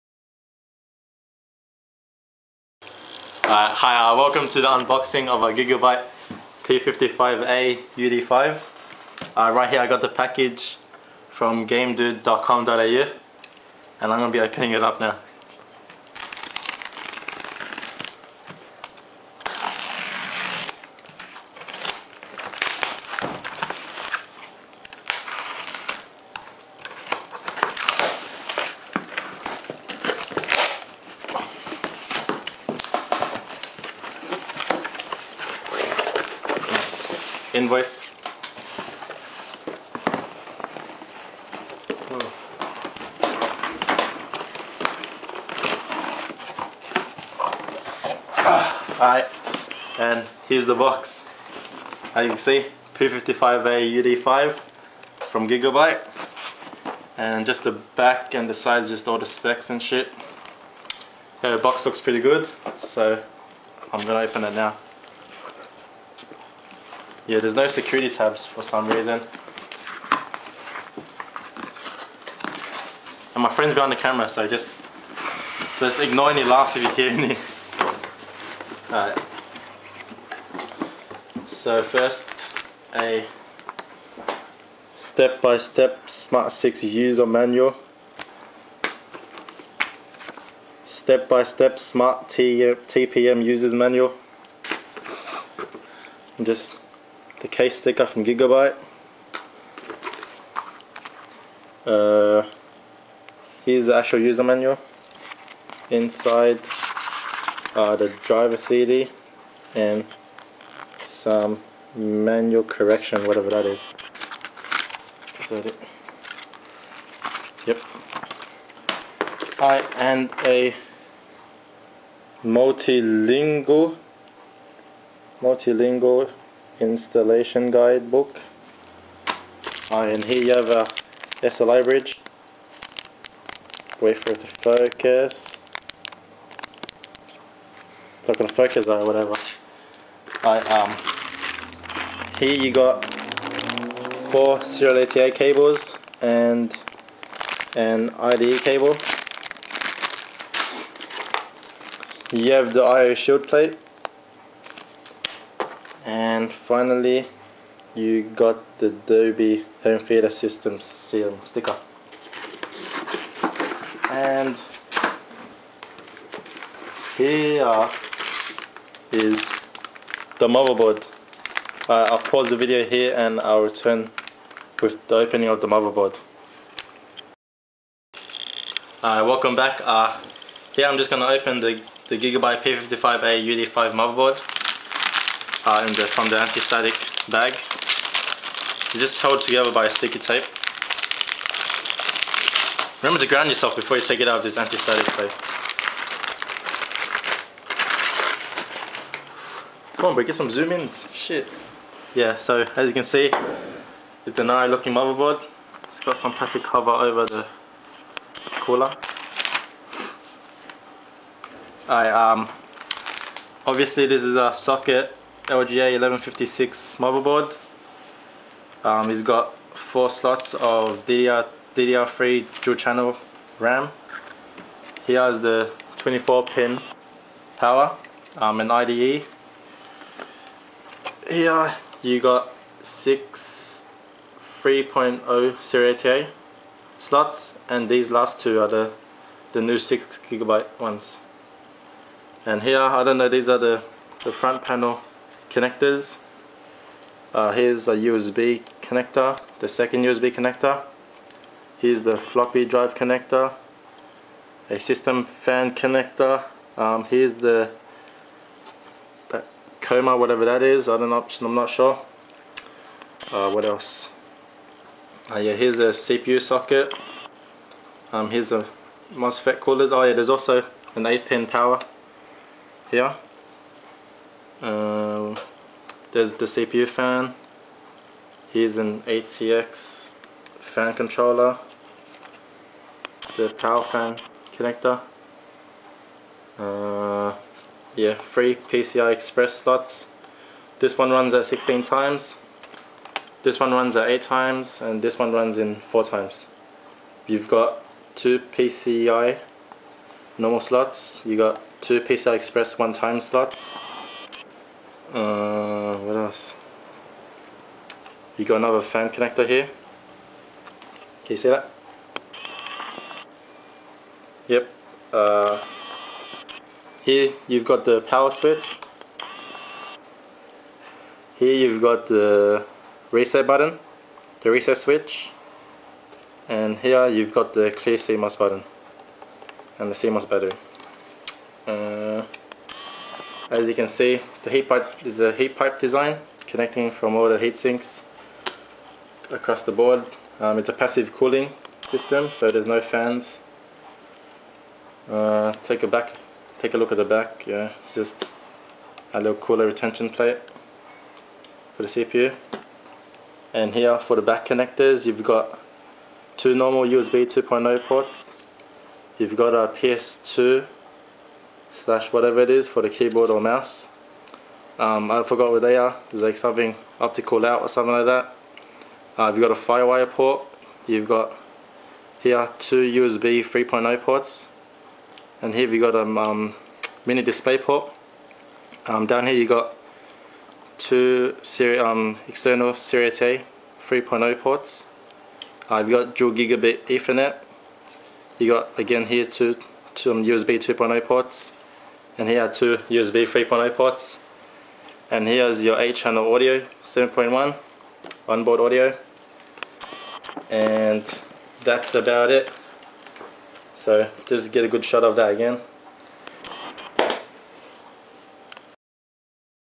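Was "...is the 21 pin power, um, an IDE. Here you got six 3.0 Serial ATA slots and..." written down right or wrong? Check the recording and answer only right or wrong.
wrong.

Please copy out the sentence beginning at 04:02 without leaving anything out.
And here, I don't know, these are the, the front panel connectors.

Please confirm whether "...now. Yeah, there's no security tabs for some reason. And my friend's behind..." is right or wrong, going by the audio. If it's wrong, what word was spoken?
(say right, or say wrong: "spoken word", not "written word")
right.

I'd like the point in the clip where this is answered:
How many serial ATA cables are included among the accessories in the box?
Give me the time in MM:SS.
02:24.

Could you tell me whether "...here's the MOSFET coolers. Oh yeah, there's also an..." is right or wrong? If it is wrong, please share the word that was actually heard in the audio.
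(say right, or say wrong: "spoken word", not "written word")
right.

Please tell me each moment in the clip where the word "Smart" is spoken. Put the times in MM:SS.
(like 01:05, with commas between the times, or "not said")
01:26, 01:31.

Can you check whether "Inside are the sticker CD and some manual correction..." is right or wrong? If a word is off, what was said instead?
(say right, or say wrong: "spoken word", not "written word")
wrong: "driver", not "sticker".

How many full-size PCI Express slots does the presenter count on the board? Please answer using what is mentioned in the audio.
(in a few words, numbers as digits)
3.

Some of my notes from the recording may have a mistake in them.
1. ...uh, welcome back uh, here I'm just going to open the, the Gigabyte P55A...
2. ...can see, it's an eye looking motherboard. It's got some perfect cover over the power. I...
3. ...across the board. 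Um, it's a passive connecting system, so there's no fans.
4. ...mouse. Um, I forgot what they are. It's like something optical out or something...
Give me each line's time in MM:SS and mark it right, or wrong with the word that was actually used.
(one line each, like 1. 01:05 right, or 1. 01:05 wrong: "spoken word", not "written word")
1. 02:59 right
2. 03:22 wrong: "cooler", not "power"
3. 05:39 wrong: "cooling", not "connecting"
4. 06:03 right.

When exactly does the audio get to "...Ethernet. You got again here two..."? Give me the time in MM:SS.
06:26.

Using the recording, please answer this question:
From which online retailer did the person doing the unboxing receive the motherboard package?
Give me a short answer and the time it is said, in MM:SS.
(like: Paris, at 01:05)
gamedude.com.au, at 00:11.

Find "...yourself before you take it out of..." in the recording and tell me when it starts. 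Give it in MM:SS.
03:13.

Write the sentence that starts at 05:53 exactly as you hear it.
And here for the back connectors, you've got two normal USB 2.0 ports.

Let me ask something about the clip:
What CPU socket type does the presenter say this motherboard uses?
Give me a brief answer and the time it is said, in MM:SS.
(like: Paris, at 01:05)
LGA 1156, at 03:35.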